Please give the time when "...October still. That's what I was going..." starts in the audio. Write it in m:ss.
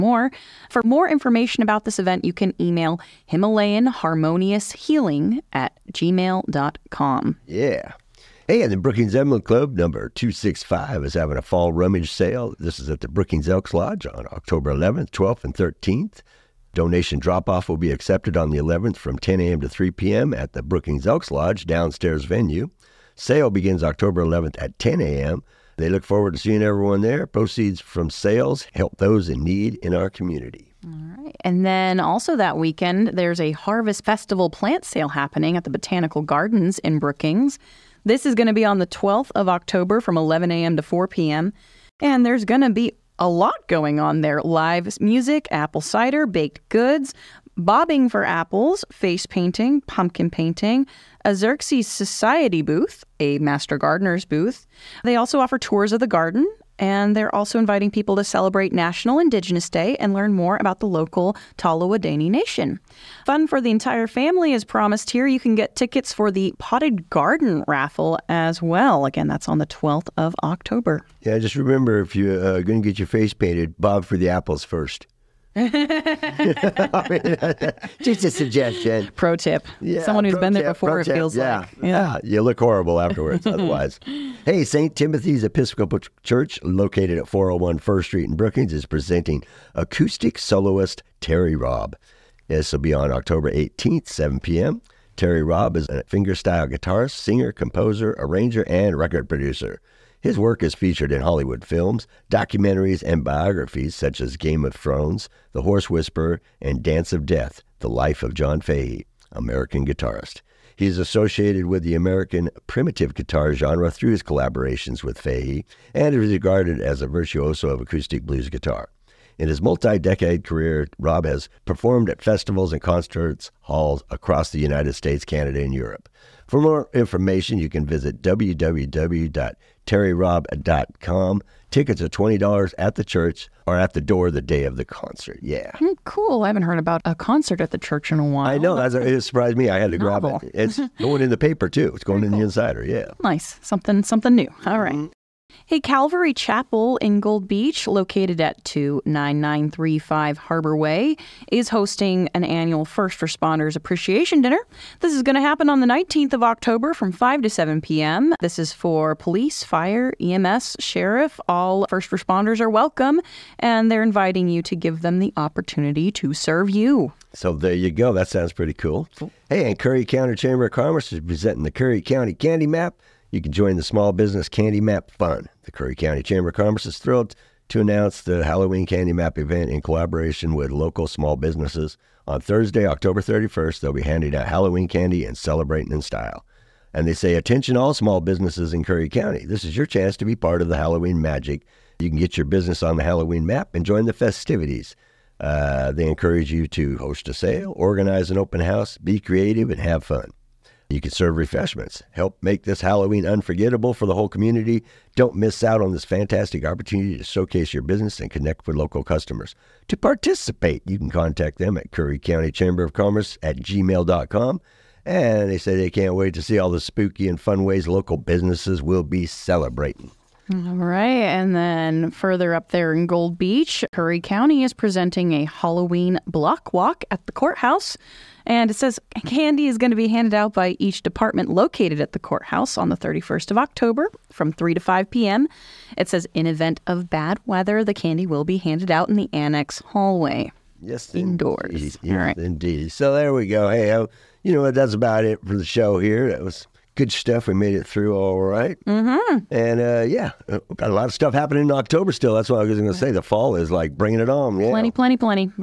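4:11.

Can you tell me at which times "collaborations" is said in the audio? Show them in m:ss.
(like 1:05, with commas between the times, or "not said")
1:54, 2:59.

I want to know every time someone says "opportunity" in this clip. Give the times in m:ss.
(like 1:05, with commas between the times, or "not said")
2:45, 3:26.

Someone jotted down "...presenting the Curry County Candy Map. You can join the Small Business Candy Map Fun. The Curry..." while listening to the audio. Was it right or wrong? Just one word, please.
right.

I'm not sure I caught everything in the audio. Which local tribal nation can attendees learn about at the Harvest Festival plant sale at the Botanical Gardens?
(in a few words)
Tolowa Dee-ni' Nation.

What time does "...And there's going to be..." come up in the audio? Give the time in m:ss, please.
0:41.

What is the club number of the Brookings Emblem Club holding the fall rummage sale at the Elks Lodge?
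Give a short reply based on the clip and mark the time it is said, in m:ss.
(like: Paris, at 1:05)
265, at 0:10.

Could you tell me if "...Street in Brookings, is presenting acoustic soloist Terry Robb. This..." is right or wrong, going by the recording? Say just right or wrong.
right.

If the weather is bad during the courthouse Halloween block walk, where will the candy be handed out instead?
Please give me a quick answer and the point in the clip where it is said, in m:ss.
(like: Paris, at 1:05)
The annex hallway, at 3:59.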